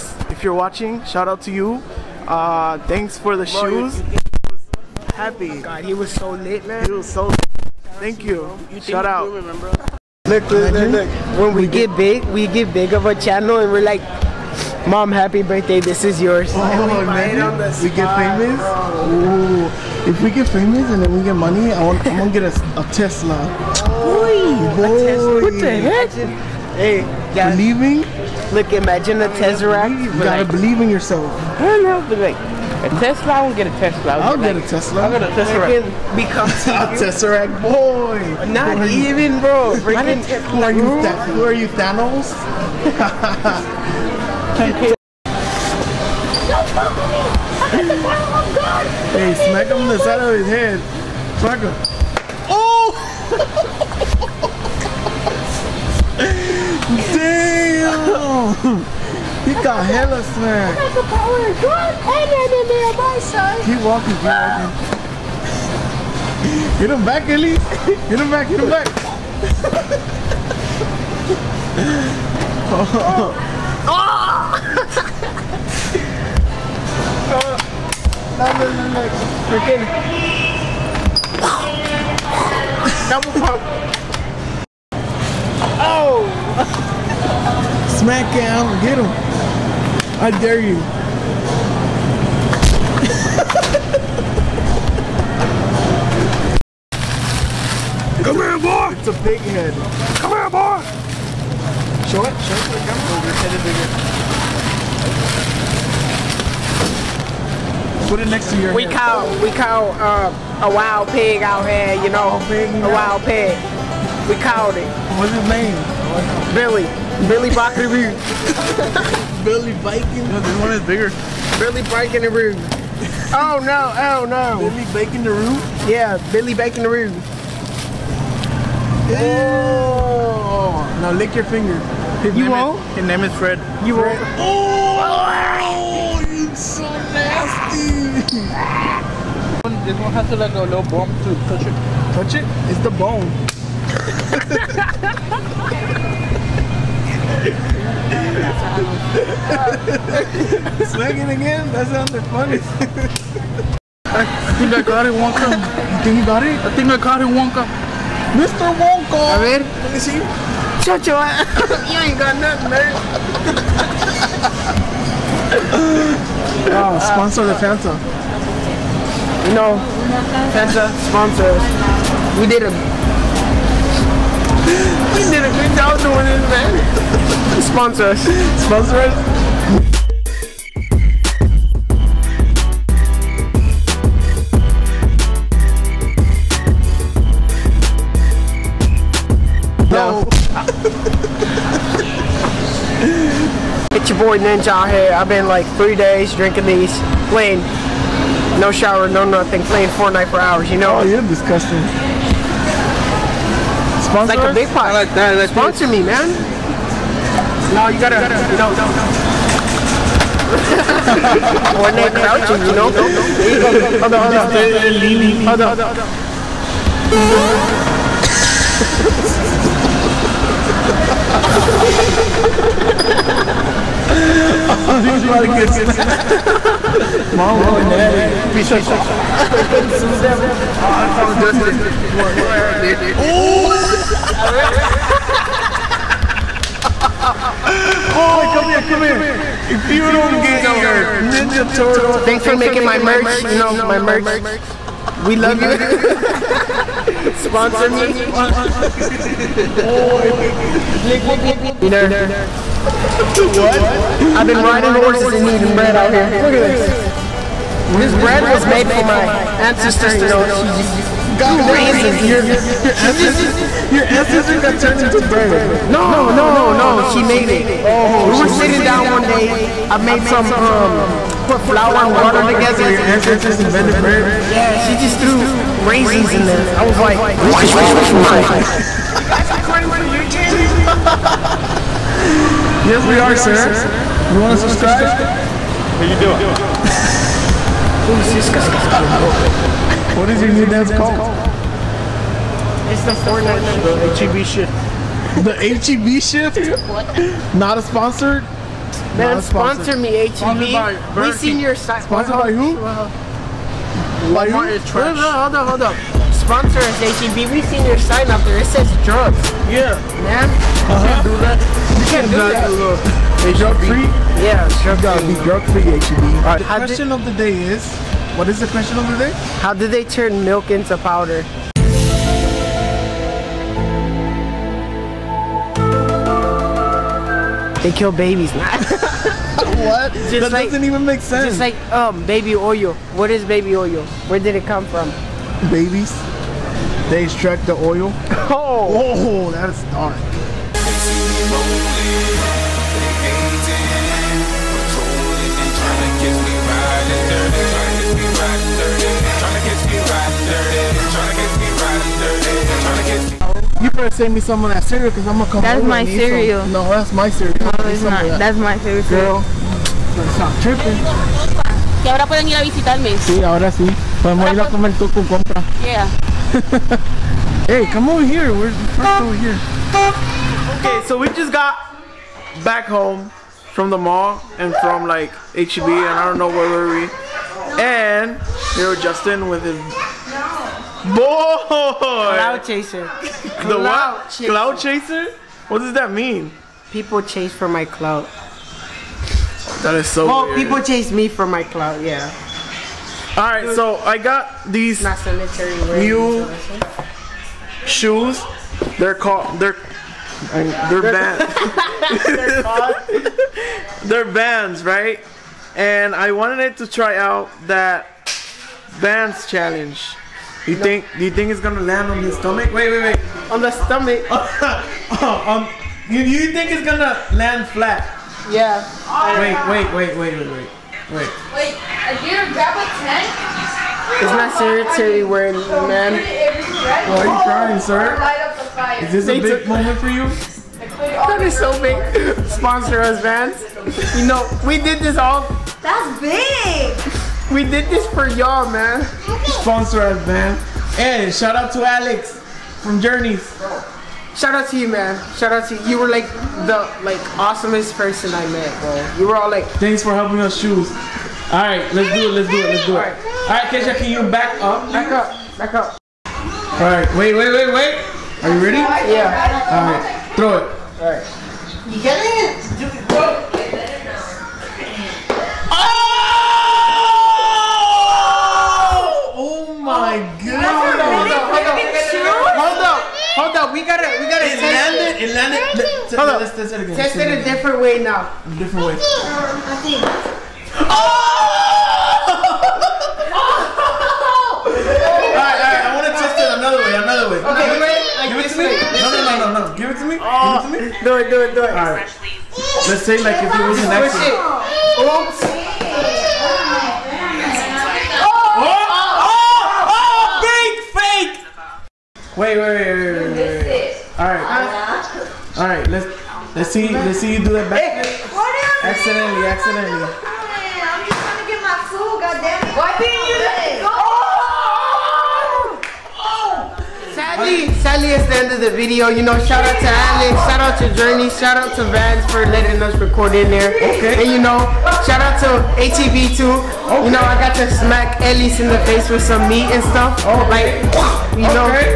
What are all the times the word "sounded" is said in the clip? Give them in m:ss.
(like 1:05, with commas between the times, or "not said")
2:31.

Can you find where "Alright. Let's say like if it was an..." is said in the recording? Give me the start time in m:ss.
8:11.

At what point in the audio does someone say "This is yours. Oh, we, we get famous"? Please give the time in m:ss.
0:15.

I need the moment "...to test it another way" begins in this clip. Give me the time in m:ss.
8:06.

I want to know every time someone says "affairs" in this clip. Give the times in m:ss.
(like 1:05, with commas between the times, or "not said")
not said.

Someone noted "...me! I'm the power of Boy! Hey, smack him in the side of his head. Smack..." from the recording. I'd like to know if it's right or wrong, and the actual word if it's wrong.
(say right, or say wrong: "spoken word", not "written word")
wrong: "God", not "Boy".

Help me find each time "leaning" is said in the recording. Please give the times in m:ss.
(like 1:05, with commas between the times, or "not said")
3:34.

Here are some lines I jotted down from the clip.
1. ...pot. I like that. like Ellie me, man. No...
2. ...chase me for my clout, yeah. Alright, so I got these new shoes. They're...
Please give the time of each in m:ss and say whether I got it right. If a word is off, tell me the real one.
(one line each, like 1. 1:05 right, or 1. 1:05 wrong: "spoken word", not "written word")
1. 3:24 wrong: "Sponsor", not "Ellie"
2. 6:30 right.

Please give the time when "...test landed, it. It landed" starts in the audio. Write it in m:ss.
7:54.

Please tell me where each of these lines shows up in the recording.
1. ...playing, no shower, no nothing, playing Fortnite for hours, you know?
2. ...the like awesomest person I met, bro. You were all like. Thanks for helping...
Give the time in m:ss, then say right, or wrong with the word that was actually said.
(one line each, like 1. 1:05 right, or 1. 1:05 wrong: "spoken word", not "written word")
1. 3:17 right
2. 7:26 right.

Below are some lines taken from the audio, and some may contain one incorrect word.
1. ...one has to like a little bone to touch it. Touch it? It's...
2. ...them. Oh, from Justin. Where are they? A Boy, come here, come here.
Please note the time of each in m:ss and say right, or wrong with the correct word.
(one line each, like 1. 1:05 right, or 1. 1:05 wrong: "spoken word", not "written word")
1. 2:19 right
2. 3:50 right.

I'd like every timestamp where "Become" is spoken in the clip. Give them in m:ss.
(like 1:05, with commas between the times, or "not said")
0:36.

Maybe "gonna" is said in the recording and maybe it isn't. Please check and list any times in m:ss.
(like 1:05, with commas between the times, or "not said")
5:55, 6:51, 6:56, 7:02.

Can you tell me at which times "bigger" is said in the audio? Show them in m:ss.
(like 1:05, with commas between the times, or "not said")
1:47, 2:00.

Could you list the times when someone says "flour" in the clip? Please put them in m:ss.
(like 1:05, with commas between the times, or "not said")
4:31.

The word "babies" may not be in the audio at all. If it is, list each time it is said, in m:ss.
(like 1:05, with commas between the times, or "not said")
5:28, 5:35.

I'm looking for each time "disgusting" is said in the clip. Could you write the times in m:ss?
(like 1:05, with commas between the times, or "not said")
3:21.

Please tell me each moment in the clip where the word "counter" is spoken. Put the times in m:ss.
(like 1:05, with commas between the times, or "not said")
not said.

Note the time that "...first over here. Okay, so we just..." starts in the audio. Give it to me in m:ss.
6:08.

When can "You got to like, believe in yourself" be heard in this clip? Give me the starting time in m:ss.
0:30.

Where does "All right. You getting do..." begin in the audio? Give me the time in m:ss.
7:40.